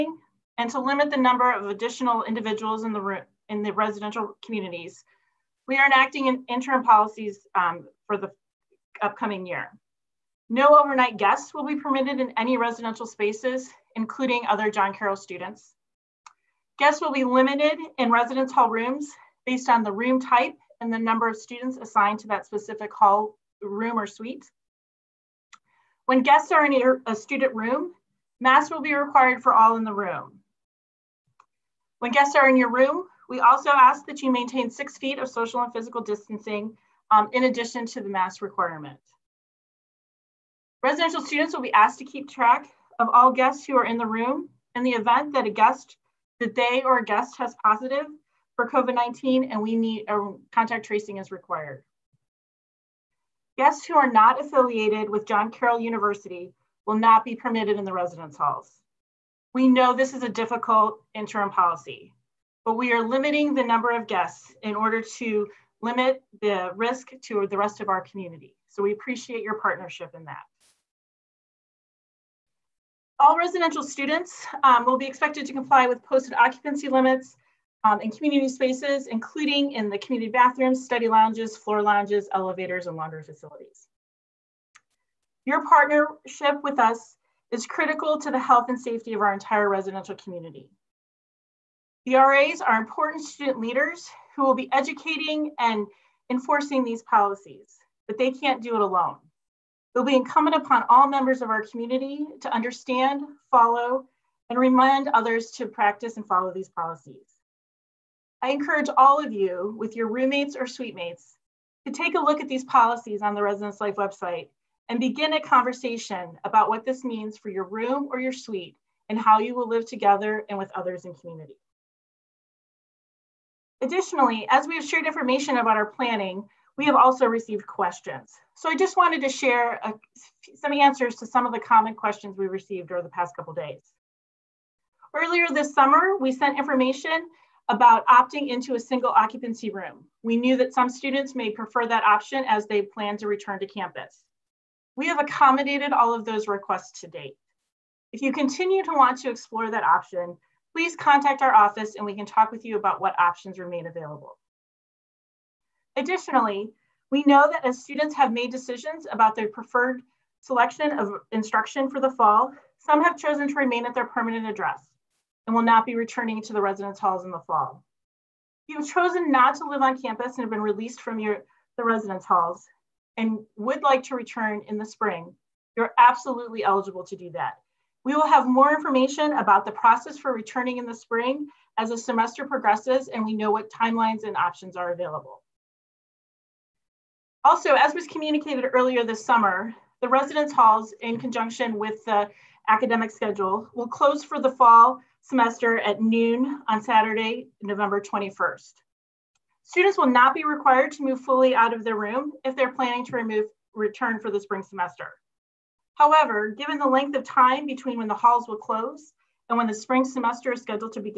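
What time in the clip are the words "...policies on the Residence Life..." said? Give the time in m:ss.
1:52.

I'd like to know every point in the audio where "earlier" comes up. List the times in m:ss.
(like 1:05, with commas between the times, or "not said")
2:15, 3:08.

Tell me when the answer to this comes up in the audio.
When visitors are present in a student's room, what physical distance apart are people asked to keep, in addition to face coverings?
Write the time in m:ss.
0:34.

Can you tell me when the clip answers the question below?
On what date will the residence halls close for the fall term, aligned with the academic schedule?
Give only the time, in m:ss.
3:16.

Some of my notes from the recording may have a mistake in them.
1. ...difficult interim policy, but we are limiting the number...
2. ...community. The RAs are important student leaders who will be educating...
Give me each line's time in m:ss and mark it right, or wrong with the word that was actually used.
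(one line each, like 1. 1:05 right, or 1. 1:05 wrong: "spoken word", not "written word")
1. 1:00 right
2. 1:30 right.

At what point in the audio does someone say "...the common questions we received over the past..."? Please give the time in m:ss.
2:11.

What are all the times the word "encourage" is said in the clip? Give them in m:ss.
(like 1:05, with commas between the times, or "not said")
1:48.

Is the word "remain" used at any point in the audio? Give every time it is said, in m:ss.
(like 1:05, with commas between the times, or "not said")
2:33, 2:43.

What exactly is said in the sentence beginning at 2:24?
We have accommodated all of those requests to date.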